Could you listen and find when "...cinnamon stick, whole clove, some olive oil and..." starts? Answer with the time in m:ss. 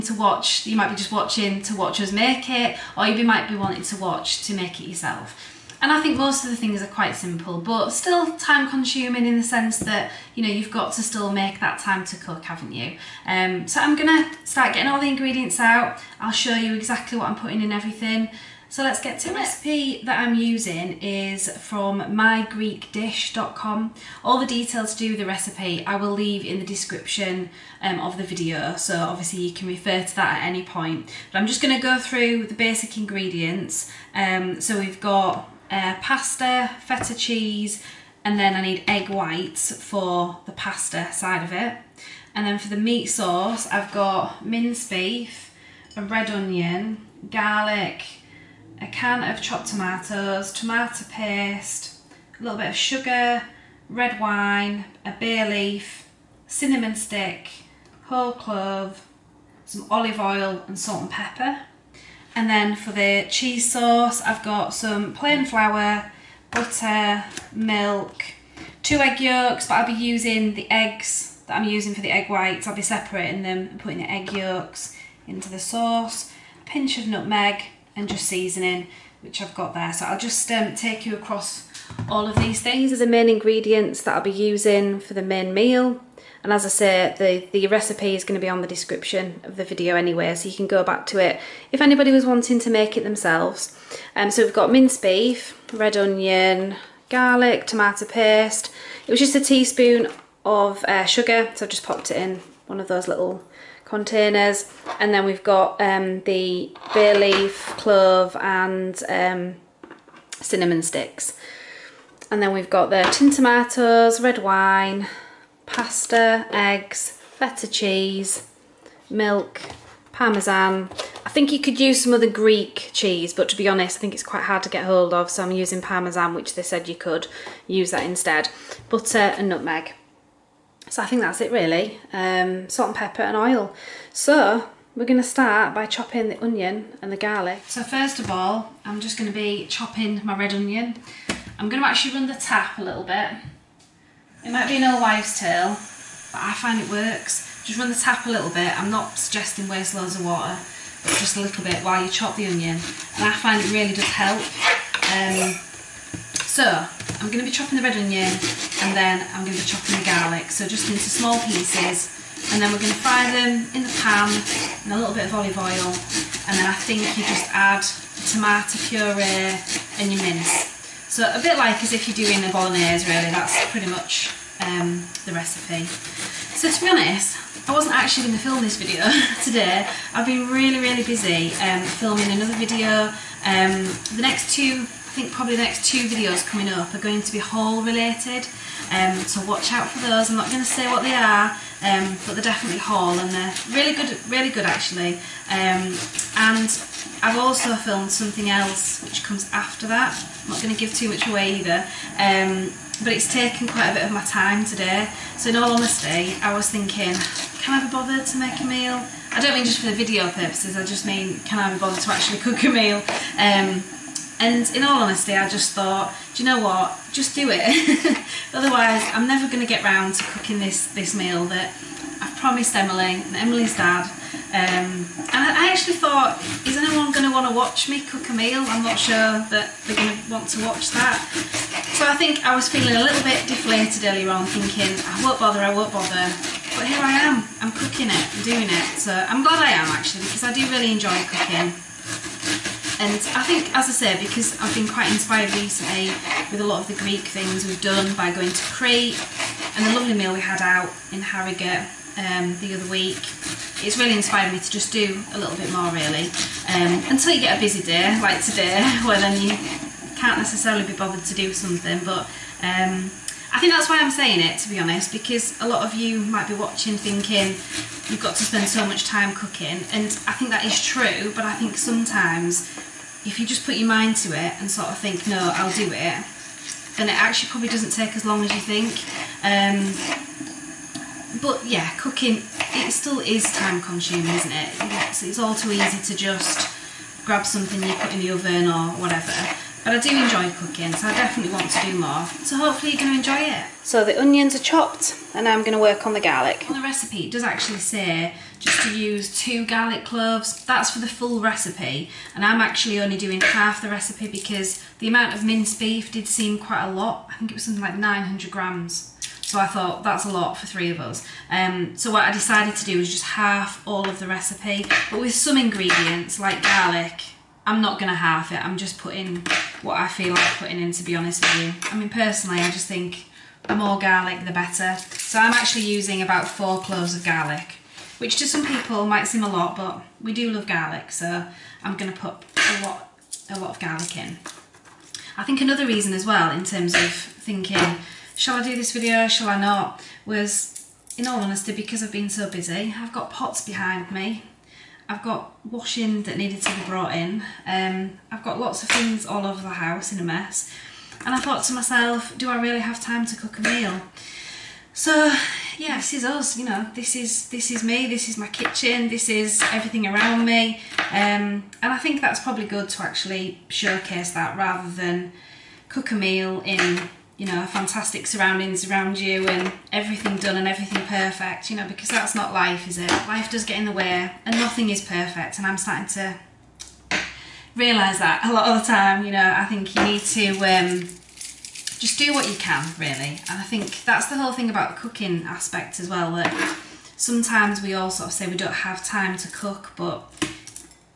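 0:56.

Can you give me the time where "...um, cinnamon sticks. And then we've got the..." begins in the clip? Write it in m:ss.
1:49.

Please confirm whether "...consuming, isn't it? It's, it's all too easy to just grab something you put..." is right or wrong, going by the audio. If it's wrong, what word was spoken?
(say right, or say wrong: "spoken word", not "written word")
right.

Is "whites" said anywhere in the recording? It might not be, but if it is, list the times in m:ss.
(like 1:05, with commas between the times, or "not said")
0:39, 1:12.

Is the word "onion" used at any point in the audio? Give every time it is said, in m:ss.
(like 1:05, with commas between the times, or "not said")
0:46, 1:35, 2:16, 2:20, 2:32, 2:37, 4:54.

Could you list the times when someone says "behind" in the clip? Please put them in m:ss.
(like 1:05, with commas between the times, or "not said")
5:43.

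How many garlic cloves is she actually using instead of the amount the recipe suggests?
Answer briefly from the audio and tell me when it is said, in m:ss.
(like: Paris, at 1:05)
4, at 5:26.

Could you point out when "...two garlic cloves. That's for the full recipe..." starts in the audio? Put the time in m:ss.
4:59.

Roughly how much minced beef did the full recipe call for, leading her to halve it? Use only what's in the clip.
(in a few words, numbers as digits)
900 grams.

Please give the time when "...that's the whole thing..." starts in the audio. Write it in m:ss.
6:24.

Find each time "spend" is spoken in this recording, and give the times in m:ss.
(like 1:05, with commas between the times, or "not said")
4:28.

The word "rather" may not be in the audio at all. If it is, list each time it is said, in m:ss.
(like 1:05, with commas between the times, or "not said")
6:04.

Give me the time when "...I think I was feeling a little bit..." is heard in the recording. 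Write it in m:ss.
3:52.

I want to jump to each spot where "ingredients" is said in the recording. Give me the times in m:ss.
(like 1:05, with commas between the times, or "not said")
0:15, 0:32, 1:23, 5:15.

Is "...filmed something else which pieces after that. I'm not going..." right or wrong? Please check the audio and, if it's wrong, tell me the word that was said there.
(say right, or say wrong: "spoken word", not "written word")
wrong: "comes", not "pieces".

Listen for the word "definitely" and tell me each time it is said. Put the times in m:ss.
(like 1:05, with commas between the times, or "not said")
3:12, 4:51.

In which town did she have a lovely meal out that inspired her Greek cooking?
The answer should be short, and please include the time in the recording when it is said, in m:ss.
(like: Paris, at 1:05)
Harrogate, at 4:11.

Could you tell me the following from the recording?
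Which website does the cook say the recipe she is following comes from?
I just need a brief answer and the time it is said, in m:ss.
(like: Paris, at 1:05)
mygreekdish.com, at 0:21.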